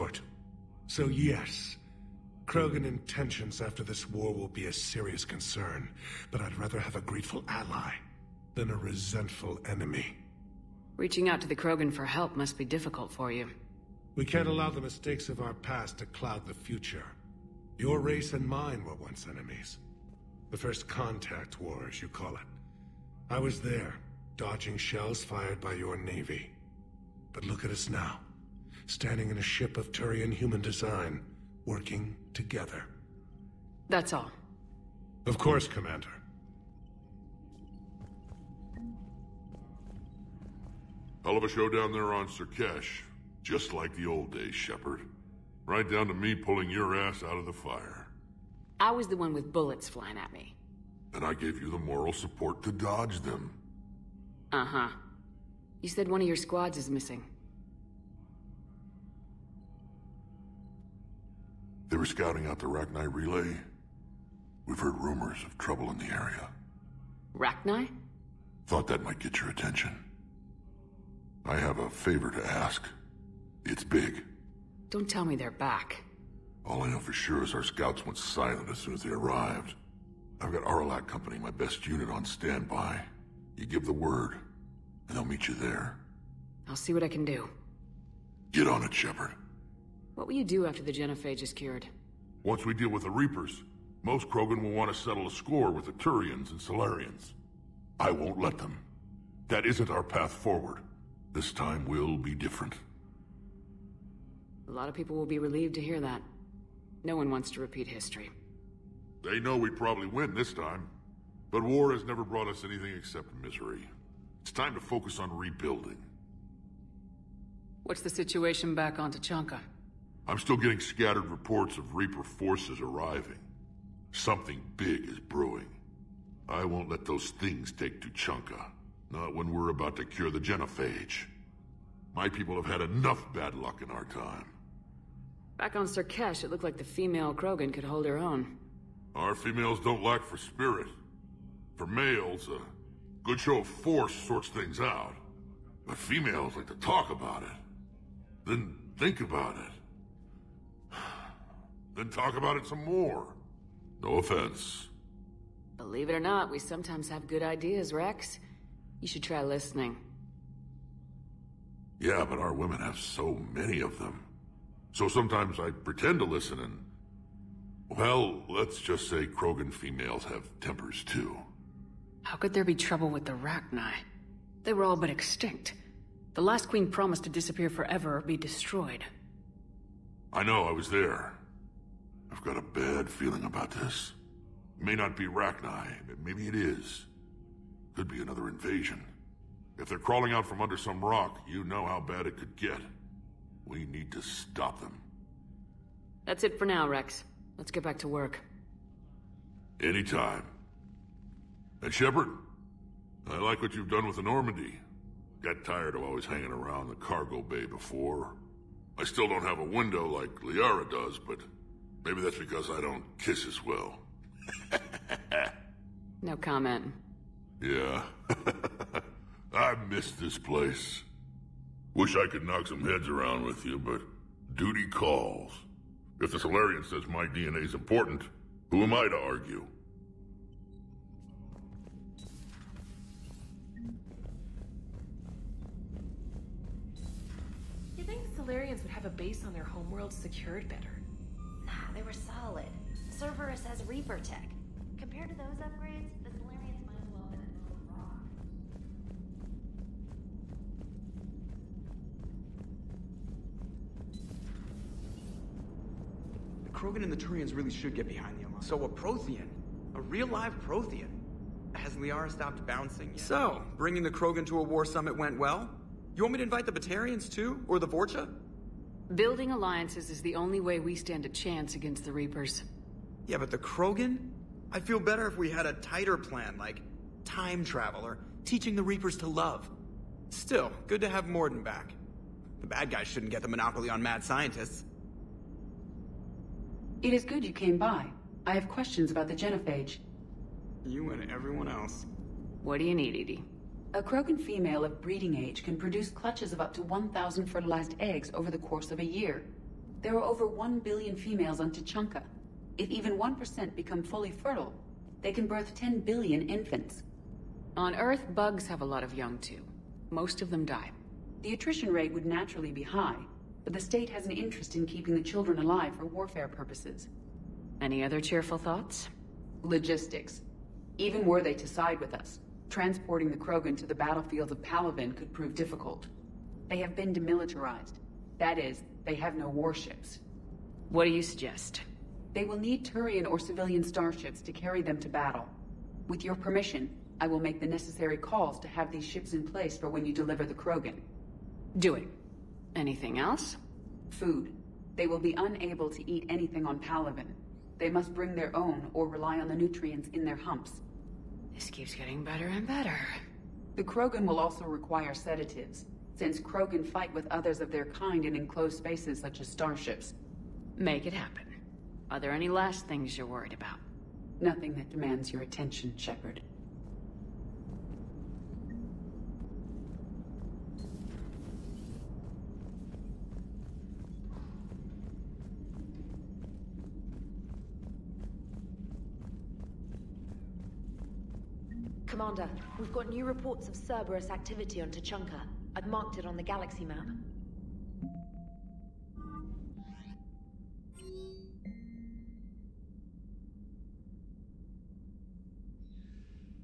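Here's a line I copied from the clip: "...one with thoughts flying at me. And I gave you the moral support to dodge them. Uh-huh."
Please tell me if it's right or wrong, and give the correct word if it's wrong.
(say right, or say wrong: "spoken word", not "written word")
wrong: "bullets", not "thoughts".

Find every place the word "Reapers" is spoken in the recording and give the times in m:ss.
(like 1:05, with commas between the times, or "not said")
1:33, 2:01, 4:03, 4:32, 4:38.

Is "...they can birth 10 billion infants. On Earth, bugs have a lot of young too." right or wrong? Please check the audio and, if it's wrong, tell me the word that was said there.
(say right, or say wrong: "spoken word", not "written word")
right.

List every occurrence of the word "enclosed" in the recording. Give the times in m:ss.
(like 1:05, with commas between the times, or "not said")
5:58.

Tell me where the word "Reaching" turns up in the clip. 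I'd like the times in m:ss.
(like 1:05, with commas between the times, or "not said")
0:10.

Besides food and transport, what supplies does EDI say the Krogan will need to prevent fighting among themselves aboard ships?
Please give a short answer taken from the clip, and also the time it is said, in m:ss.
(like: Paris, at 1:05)
Sedatives, at 5:55.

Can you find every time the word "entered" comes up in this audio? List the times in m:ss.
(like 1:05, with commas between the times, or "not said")
not said.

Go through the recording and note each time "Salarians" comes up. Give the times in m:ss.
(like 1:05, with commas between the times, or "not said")
1:36, 3:46, 3:58.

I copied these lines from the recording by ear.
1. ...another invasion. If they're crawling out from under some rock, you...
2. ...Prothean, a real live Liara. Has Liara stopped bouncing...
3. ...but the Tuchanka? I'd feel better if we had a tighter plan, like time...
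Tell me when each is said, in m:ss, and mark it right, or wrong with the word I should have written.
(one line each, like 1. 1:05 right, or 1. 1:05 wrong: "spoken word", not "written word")
1. 3:08 right
2. 4:18 wrong: "Prothean", not "Liara"
3. 4:33 wrong: "Krogan", not "Tuchanka".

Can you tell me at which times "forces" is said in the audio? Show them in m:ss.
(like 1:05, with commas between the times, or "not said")
2:02, 2:23.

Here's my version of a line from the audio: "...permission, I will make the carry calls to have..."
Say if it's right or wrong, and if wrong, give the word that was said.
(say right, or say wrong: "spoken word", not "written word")
wrong: "necessary", not "carry".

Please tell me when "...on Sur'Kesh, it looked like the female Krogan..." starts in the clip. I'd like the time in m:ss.
2:15.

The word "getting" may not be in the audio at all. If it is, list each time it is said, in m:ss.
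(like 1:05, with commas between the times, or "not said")
2:00, 5:51.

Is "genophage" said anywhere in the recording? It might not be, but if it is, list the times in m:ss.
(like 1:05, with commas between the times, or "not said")
1:30, 2:10, 4:49.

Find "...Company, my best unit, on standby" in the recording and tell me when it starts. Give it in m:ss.
1:21.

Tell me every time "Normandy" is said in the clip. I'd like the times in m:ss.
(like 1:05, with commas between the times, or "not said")
3:24.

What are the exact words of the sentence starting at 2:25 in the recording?
But females like to talk about it.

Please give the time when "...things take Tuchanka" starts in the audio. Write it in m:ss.
2:07.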